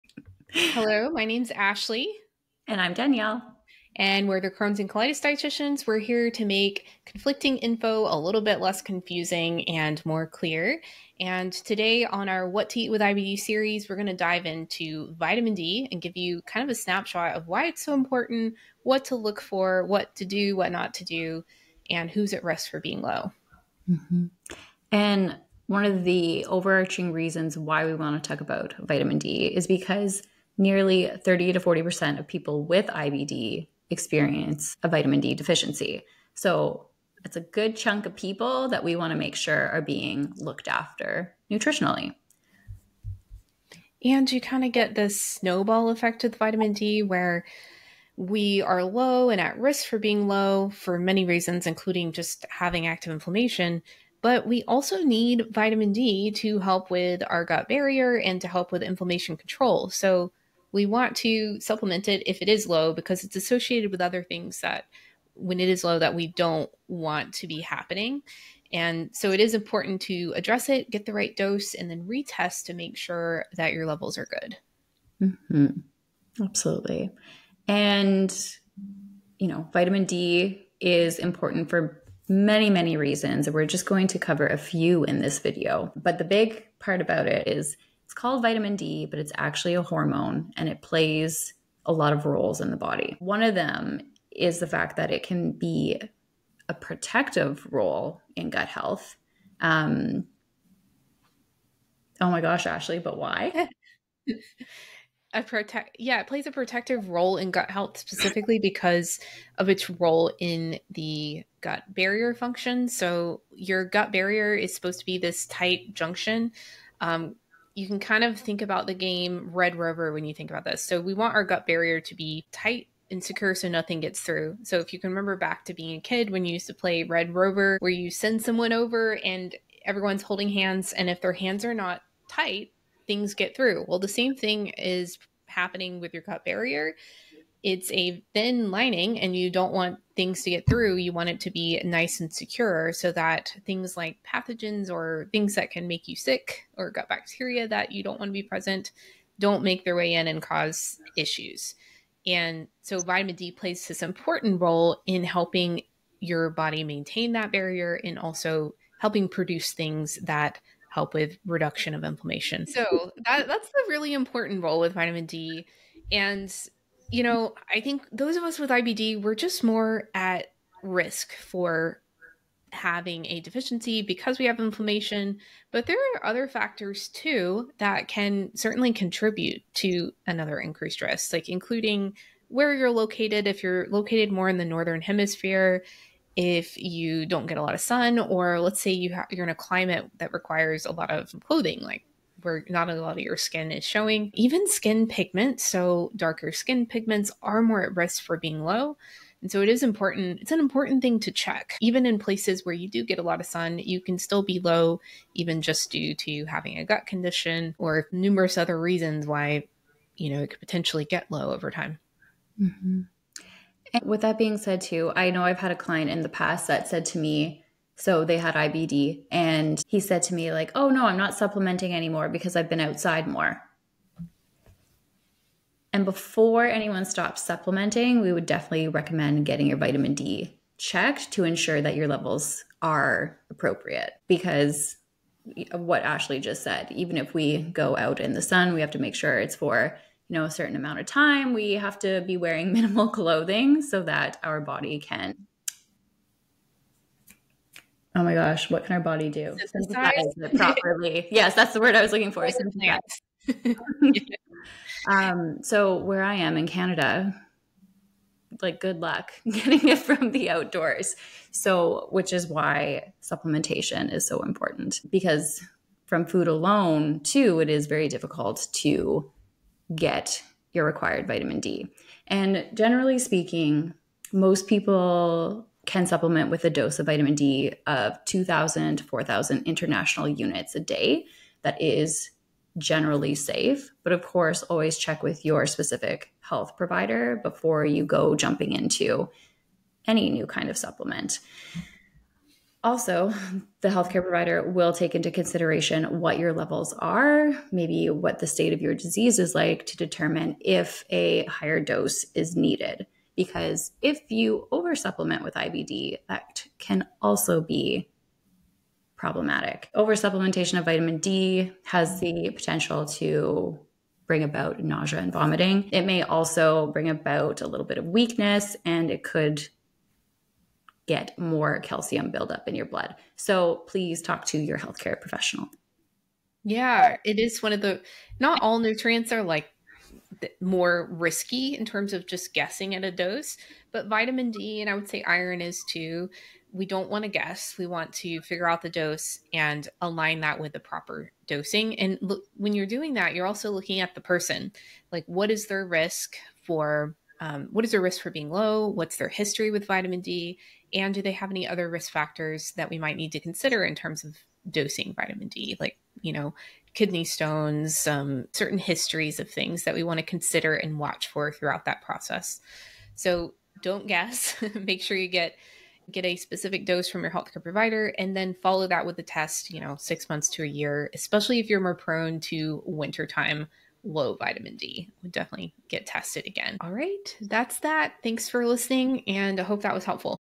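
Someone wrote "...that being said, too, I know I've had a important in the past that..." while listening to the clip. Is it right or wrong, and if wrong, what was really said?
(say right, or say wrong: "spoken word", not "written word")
wrong: "client", not "important".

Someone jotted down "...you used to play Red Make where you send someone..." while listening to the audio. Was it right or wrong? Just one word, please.
wrong.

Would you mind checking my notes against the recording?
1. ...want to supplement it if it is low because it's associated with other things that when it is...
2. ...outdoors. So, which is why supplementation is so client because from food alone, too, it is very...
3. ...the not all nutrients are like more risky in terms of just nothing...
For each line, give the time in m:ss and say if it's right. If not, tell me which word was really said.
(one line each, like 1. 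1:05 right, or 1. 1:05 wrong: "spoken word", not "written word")
1. 1:00 right
2. 4:20 wrong: "important", not "client"
3. 5:27 wrong: "guessing", not "nothing".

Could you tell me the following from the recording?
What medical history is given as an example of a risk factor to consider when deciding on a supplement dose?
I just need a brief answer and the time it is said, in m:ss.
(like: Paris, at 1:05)
kidney stones, at 5:56.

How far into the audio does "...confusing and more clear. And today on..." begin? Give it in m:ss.
0:08.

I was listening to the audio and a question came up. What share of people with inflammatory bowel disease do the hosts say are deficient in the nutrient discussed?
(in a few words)
30 to 40%.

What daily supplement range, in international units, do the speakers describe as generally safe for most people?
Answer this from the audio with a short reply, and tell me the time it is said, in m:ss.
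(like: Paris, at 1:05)
2,000 to 4,000, at 4:38.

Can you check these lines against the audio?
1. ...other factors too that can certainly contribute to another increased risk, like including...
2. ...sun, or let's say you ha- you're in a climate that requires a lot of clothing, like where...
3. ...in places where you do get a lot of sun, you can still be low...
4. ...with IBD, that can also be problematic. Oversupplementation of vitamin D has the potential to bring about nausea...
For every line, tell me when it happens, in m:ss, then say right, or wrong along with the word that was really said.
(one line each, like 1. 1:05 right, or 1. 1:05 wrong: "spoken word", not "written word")
1. 2:56 right
2. 3:07 right
3. 3:22 right
4. 5:05 right.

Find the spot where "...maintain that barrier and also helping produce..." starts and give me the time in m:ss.
2:36.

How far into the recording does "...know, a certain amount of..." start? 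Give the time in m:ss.
4:00.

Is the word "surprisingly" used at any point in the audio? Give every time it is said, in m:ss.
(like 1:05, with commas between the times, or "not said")
not said.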